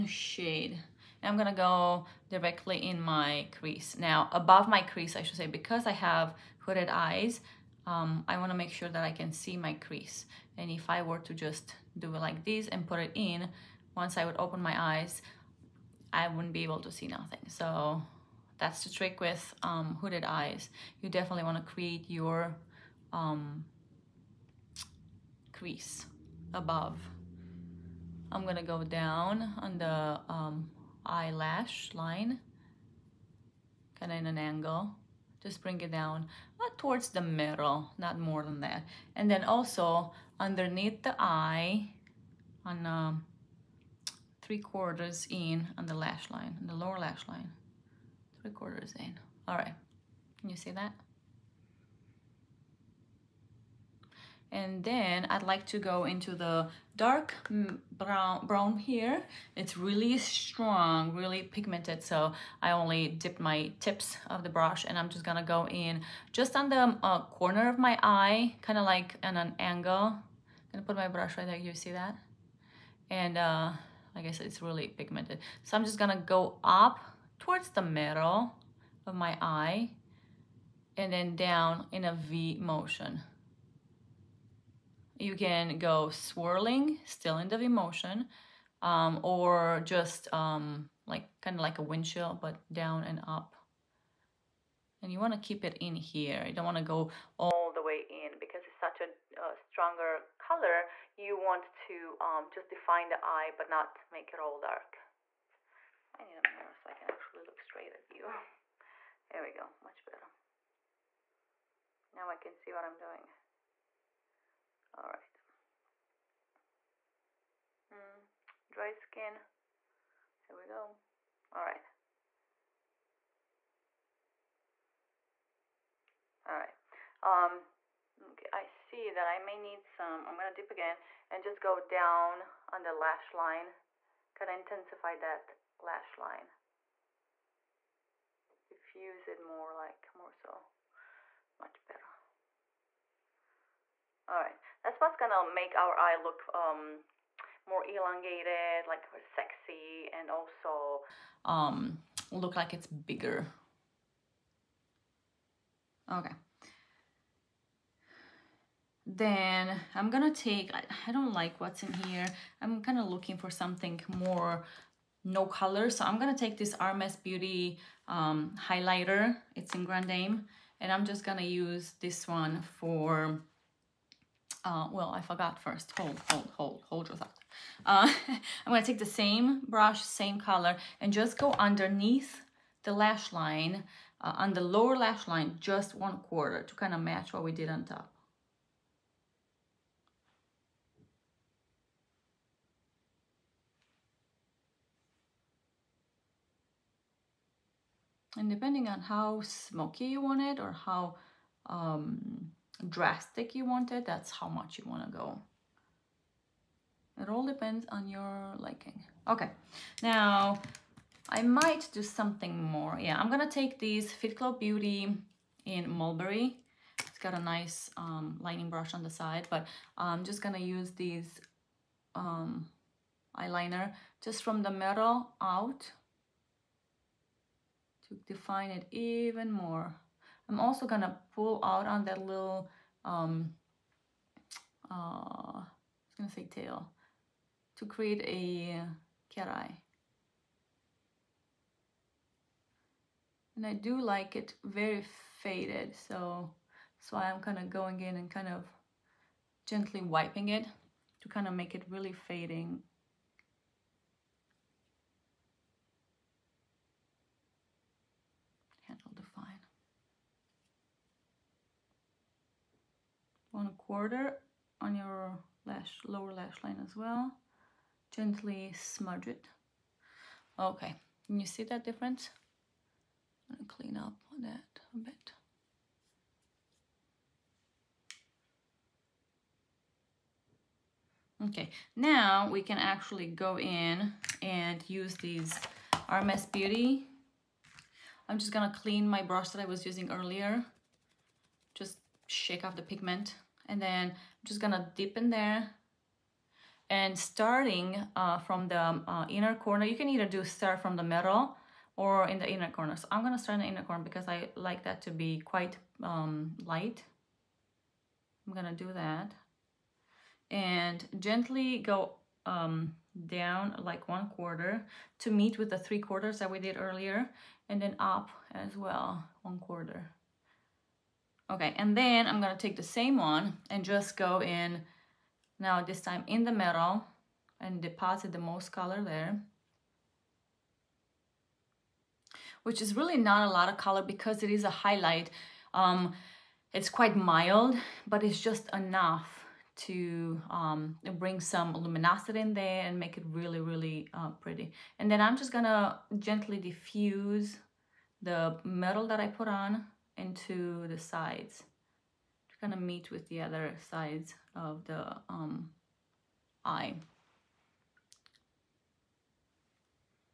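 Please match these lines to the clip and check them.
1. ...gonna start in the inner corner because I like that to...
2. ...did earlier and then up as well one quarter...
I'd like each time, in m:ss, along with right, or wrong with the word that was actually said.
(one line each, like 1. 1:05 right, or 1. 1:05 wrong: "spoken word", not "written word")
1. 5:03 right
2. 5:16 right.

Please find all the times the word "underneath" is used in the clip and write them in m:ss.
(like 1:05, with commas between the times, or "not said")
0:40, 3:01.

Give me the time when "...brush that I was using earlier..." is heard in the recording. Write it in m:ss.
4:49.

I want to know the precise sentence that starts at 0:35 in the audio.
Just bring it down, not towards the middle, not more than that.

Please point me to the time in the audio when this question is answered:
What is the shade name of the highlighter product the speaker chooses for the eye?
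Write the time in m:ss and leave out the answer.
2:49.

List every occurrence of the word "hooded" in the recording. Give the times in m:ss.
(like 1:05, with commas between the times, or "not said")
0:06, 0:20.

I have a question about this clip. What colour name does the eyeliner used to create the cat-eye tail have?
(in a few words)
Mulberry.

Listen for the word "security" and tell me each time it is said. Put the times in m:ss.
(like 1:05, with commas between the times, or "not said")
not said.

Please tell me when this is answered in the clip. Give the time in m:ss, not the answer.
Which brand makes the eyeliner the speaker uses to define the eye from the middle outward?
3:34.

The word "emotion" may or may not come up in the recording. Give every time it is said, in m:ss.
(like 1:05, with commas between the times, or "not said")
1:27.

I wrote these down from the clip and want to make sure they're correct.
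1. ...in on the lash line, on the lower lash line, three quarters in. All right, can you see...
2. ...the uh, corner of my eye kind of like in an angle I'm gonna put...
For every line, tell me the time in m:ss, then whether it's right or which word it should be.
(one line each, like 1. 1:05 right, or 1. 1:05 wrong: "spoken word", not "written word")
1. 0:45 right
2. 1:06 right.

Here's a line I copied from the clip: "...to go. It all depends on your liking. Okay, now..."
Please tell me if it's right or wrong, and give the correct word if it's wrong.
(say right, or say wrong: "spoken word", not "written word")
right.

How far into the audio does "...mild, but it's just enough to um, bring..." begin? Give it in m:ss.
5:37.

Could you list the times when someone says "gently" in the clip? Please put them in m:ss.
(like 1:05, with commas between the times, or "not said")
4:09, 4:28, 5:11, 5:46.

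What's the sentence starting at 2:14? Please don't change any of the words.
Kind of intensify that lash line.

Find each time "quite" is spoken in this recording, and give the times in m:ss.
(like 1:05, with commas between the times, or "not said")
5:05, 5:36.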